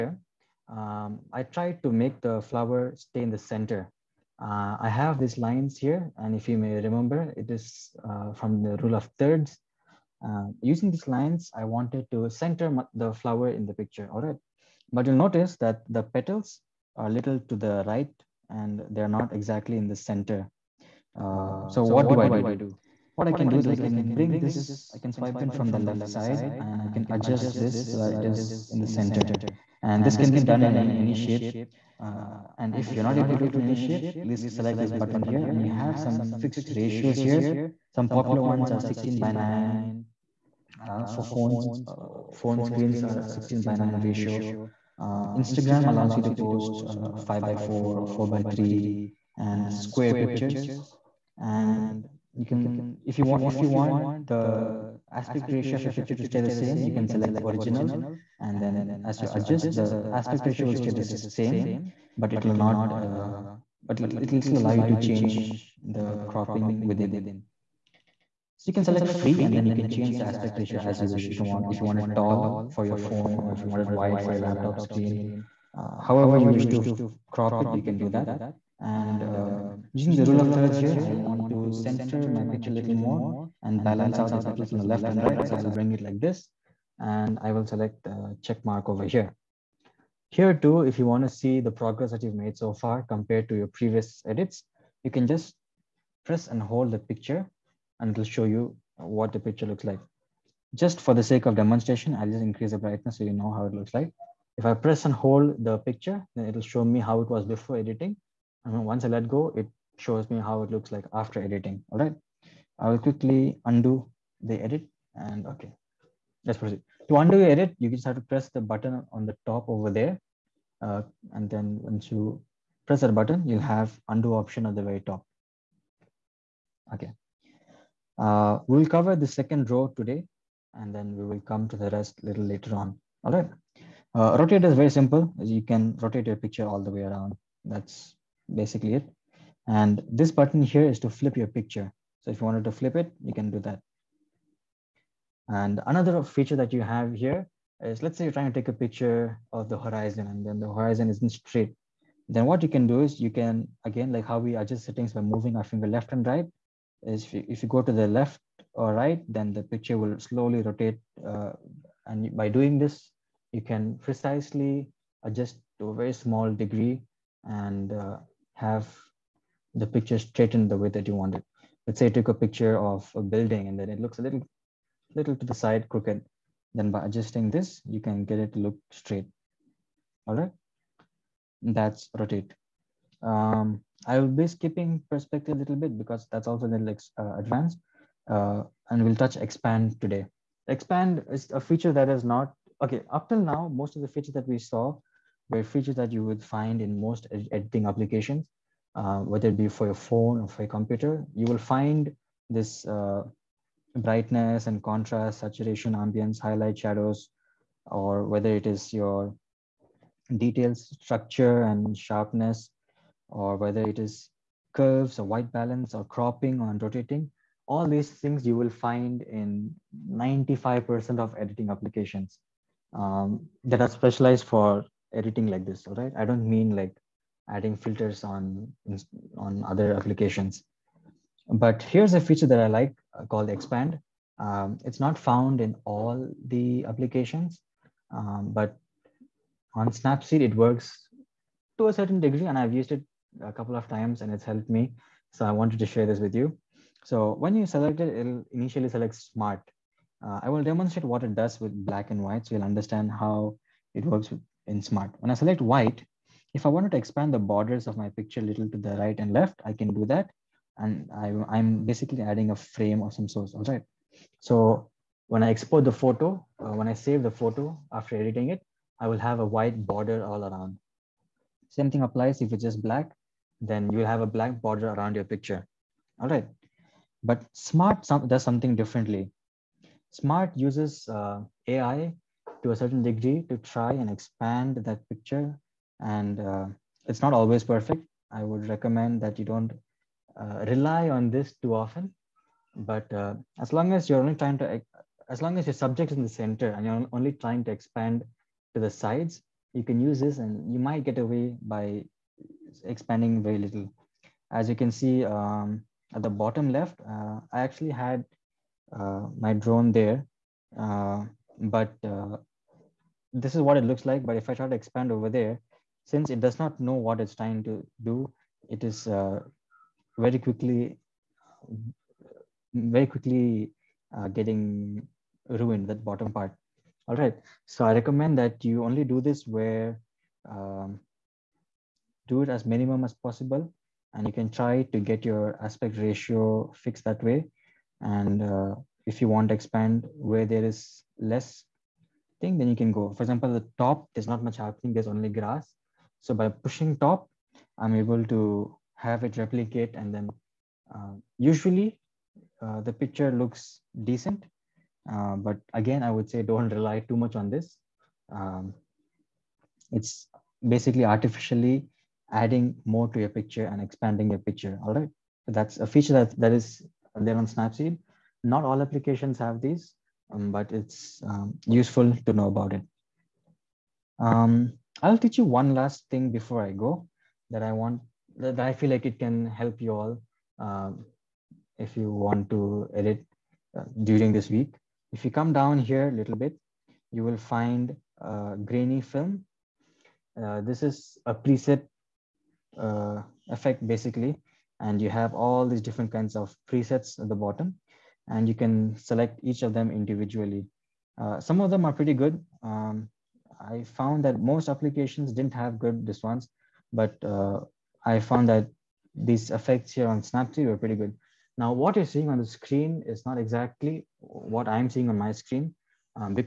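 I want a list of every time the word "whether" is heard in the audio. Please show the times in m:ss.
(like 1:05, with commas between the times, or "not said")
3:19, 3:28, 3:33.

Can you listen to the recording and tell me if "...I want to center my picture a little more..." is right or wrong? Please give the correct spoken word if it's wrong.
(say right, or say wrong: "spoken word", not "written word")
right.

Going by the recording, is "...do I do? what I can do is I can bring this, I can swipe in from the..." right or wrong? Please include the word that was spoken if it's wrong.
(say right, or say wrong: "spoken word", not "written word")
right.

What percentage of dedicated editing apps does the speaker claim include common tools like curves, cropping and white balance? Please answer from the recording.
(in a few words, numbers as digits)
95%.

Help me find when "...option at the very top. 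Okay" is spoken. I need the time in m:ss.
2:04.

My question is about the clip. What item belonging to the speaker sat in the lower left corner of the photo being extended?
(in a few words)
Drone.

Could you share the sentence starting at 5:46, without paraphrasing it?
So by pushing top, I'm able to have it replicate and then uh, usually uh, the picture looks decent.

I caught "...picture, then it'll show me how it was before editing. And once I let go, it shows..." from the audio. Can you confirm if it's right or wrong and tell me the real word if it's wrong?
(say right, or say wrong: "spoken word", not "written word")
right.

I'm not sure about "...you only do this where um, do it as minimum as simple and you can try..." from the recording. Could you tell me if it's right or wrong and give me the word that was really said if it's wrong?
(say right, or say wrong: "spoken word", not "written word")
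wrong: "possible", not "simple".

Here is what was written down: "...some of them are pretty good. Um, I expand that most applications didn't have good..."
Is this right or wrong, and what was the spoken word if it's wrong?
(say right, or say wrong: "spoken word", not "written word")
wrong: "found", not "expand".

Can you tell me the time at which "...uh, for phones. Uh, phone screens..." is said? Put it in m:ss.
0:40.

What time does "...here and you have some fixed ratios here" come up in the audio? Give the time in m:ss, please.
0:35.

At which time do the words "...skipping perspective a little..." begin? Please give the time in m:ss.
3:04.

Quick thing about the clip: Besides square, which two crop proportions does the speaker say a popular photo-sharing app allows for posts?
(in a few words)
5 by 4 or 4 by 3.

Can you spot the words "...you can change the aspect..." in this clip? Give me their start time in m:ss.
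1:09.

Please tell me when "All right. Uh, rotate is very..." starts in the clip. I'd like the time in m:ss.
2:13.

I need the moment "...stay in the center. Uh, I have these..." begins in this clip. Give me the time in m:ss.
0:02.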